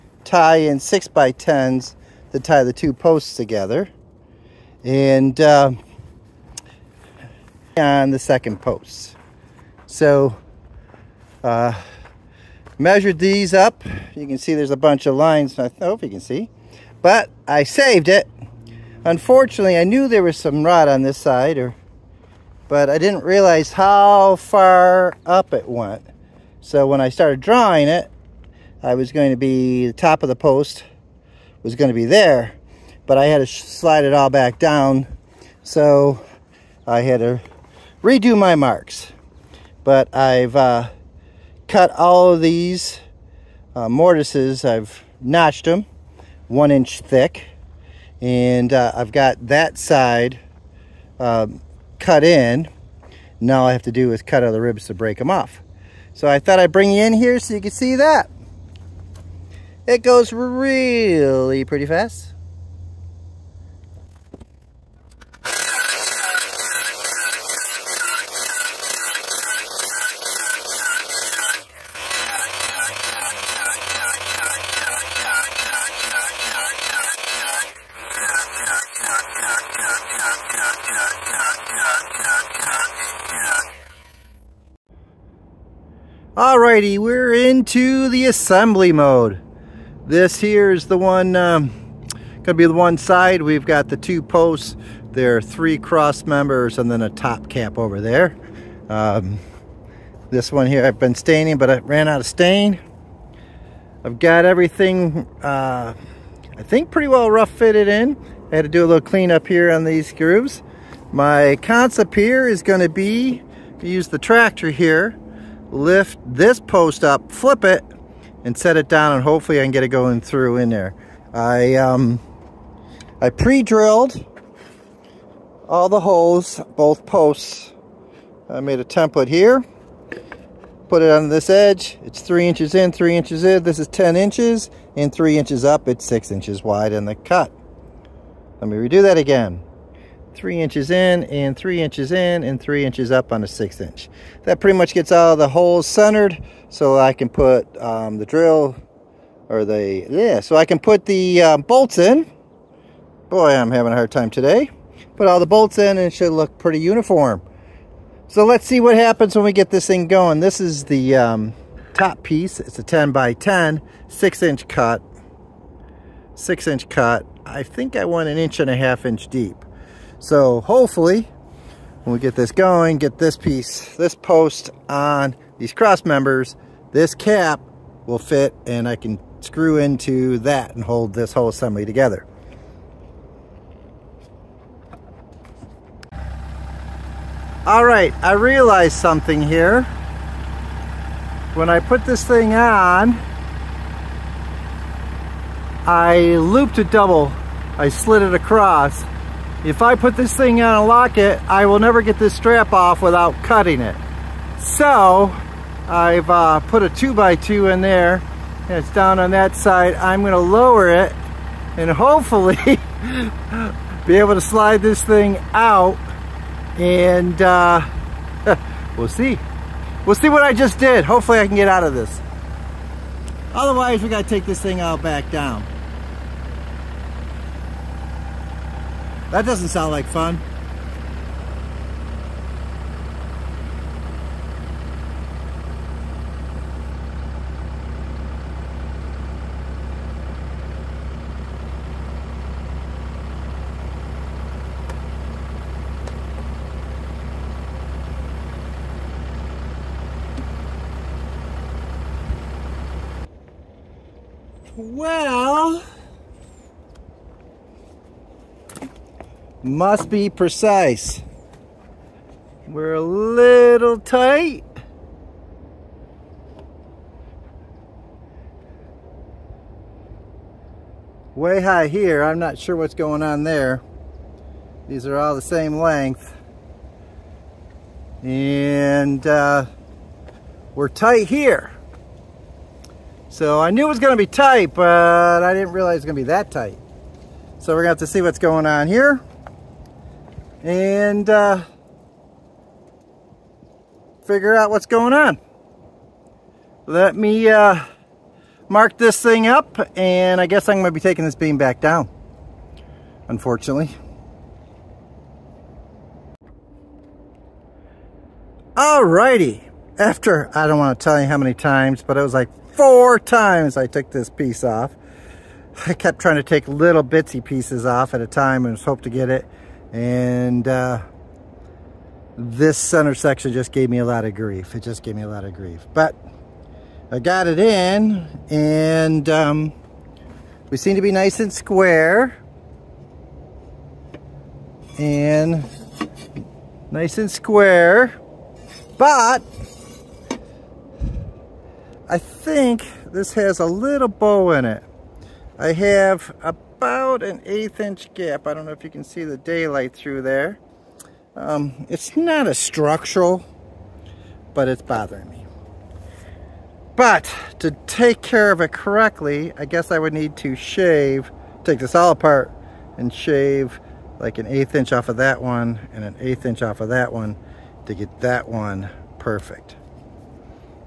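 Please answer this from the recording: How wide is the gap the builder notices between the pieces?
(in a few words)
1/8 inch.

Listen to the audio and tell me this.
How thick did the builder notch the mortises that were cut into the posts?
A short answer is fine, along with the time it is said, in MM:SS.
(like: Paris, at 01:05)
1 inch, at 00:46.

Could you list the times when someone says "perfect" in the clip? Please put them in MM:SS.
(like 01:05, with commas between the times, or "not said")
06:09.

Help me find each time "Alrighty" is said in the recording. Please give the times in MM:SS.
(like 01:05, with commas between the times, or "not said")
01:26, 05:08.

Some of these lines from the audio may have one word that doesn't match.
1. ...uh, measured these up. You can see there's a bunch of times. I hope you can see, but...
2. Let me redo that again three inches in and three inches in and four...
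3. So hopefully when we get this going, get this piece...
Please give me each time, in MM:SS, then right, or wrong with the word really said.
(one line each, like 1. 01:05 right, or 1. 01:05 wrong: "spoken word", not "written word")
1. 00:11 wrong: "lines", not "times"
2. 02:18 wrong: "three", not "four"
3. 02:50 right.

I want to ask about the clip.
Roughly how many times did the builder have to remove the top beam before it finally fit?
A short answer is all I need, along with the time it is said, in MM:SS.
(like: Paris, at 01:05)
4, at 05:12.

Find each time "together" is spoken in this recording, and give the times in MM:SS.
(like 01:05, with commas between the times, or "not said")
00:03, 03:01.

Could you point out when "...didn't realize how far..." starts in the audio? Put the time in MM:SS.
00:22.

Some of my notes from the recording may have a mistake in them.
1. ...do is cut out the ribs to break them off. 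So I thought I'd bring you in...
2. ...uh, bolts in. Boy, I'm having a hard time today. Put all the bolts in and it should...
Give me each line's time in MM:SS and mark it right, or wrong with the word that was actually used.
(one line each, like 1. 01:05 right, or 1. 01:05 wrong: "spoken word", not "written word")
1. 00:53 right
2. 02:31 right.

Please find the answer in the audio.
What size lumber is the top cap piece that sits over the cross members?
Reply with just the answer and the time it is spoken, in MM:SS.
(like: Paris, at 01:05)
10 by 10, at 02:42.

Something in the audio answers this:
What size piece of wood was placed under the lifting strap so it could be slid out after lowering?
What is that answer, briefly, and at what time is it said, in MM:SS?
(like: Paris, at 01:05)
2x2, at 03:26.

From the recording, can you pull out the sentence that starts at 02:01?
I, um, I pre-drilled all the holes, both posts.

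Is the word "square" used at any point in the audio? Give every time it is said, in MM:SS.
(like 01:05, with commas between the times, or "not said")
05:31, 05:37.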